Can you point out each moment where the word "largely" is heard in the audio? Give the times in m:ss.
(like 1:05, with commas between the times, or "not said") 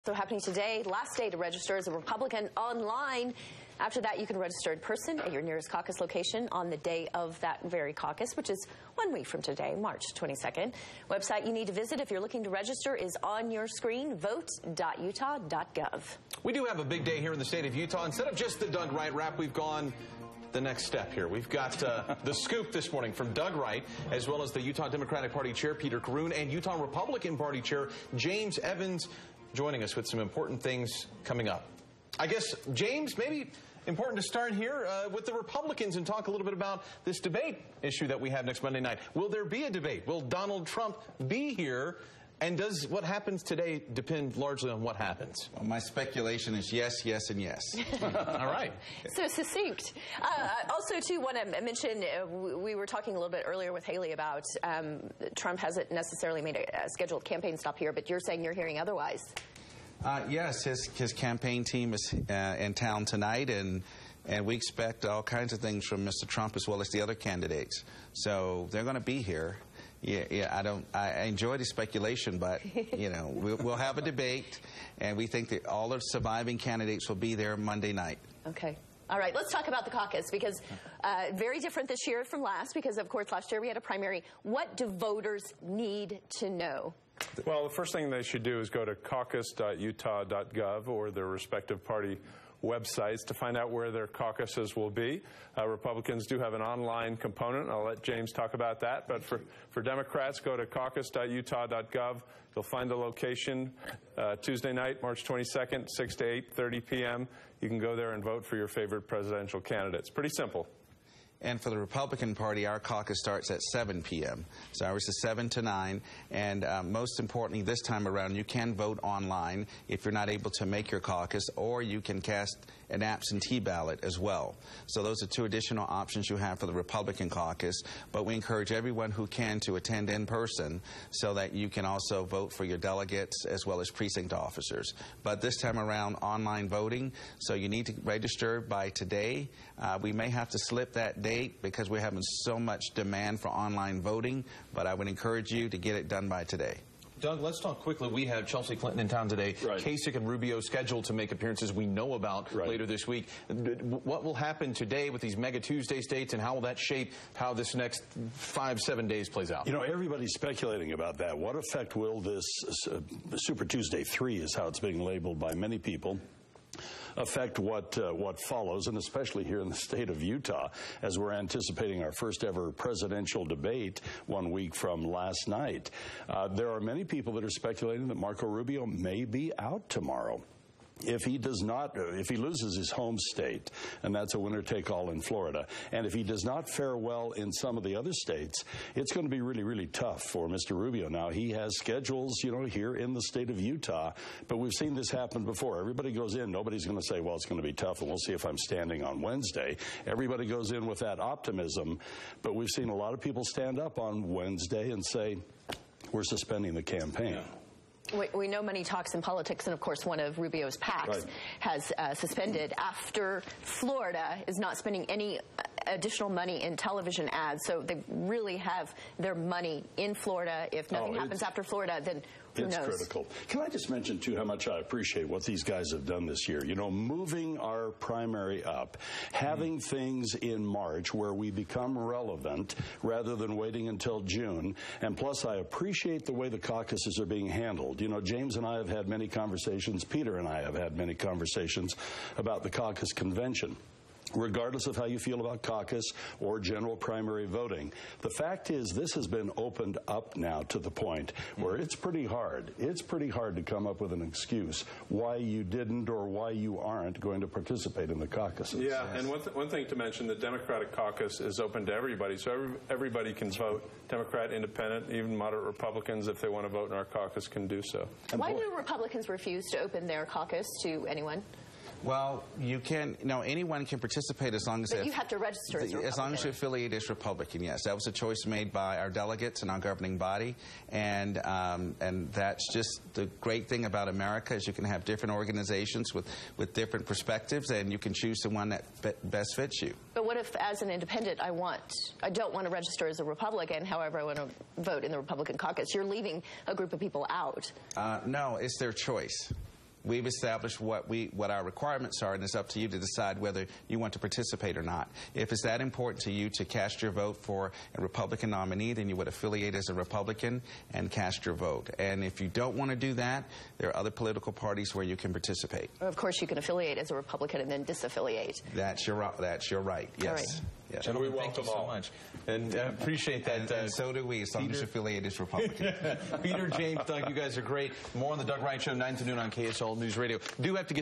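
0:44.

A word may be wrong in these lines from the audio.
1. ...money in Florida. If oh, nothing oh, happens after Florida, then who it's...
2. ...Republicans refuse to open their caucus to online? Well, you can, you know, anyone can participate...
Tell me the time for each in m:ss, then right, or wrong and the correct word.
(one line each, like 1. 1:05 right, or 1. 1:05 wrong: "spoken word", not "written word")
1. 3:39 right
2. 4:28 wrong: "anyone", not "online".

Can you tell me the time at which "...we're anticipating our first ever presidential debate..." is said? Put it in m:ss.
2:51.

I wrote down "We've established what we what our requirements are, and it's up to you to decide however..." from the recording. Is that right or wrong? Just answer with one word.
wrong.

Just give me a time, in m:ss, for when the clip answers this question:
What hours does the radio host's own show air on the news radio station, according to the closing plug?
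5:28.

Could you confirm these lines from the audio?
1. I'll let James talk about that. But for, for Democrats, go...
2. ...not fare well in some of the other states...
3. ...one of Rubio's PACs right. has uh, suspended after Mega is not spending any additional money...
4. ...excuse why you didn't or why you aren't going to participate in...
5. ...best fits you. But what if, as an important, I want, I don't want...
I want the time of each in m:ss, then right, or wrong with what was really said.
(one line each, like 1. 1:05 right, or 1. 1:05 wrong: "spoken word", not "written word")
1. 1:37 right
2. 3:06 right
3. 3:30 wrong: "Florida", not "Mega"
4. 4:14 right
5. 4:49 wrong: "independent", not "important".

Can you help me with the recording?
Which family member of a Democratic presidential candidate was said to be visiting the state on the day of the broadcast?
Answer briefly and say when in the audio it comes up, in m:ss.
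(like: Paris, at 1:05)
Chelsea Clinton, at 2:28.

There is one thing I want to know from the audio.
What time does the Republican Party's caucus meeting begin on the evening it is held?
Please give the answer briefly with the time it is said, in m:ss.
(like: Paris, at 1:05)
7 p.m., at 1:53.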